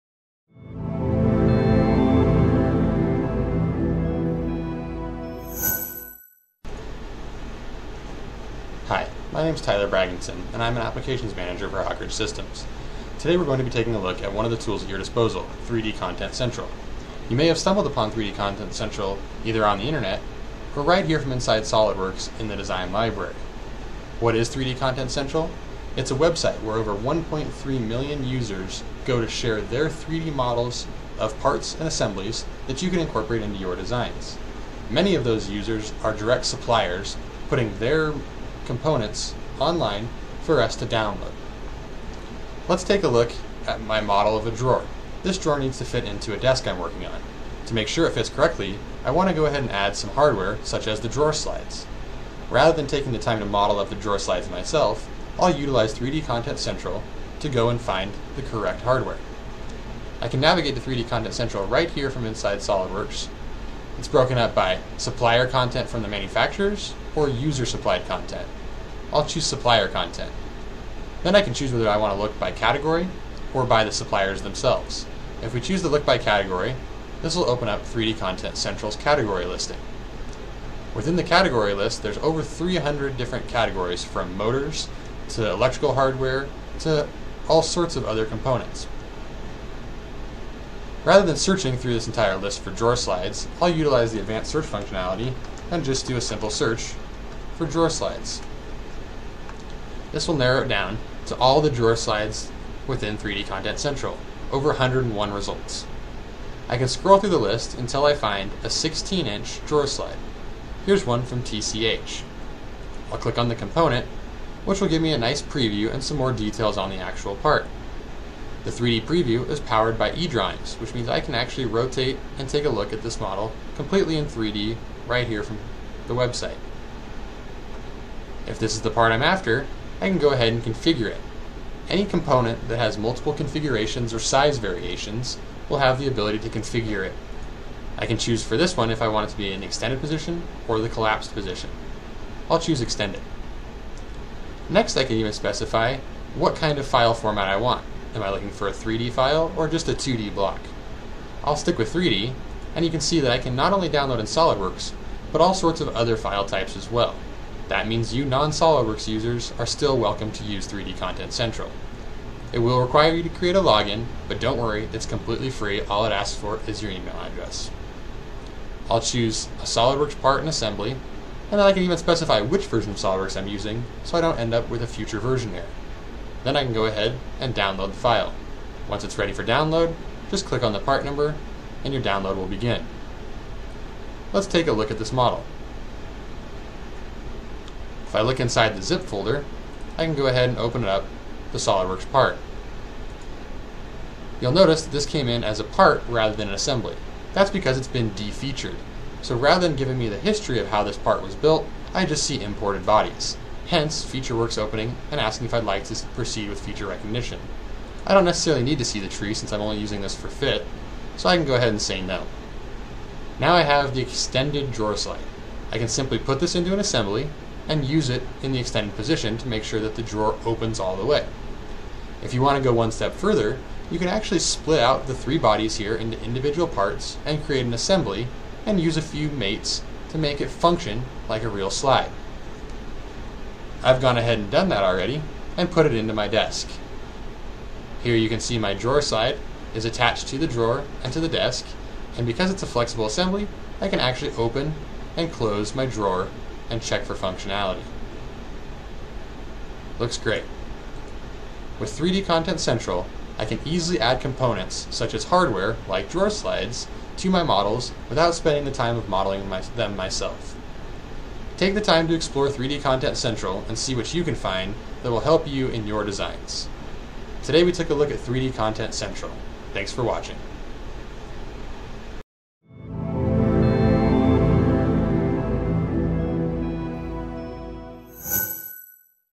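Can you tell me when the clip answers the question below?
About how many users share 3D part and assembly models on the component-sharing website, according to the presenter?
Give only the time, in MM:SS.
00:26.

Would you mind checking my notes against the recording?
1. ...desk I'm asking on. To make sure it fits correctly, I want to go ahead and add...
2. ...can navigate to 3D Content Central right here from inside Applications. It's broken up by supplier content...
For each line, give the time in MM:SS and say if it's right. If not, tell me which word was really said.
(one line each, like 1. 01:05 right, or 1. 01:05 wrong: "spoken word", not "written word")
1. 00:46 wrong: "working", not "asking"
2. 01:00 wrong: "SOLIDWORKS", not "Applications".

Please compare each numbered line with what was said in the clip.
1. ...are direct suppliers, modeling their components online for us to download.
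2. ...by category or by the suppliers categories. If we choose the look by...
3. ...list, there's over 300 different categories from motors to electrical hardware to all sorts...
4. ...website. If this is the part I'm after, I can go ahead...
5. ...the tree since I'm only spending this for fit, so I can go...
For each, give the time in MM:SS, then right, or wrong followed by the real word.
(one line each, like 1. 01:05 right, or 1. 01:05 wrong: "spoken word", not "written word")
1. 00:36 wrong: "putting", not "modeling"
2. 01:12 wrong: "themselves", not "categories"
3. 01:21 right
4. 02:06 right
5. 03:28 wrong: "using", not "spending".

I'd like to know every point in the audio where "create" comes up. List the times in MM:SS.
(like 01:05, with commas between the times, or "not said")
02:43, 03:47.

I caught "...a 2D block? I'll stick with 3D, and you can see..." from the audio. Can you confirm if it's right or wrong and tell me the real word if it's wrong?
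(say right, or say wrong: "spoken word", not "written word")
right.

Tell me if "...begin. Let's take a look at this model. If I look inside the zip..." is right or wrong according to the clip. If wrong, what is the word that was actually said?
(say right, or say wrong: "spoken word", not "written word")
right.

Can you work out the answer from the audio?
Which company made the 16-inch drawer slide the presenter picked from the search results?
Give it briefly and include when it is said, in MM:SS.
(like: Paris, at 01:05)
TCH, at 01:51.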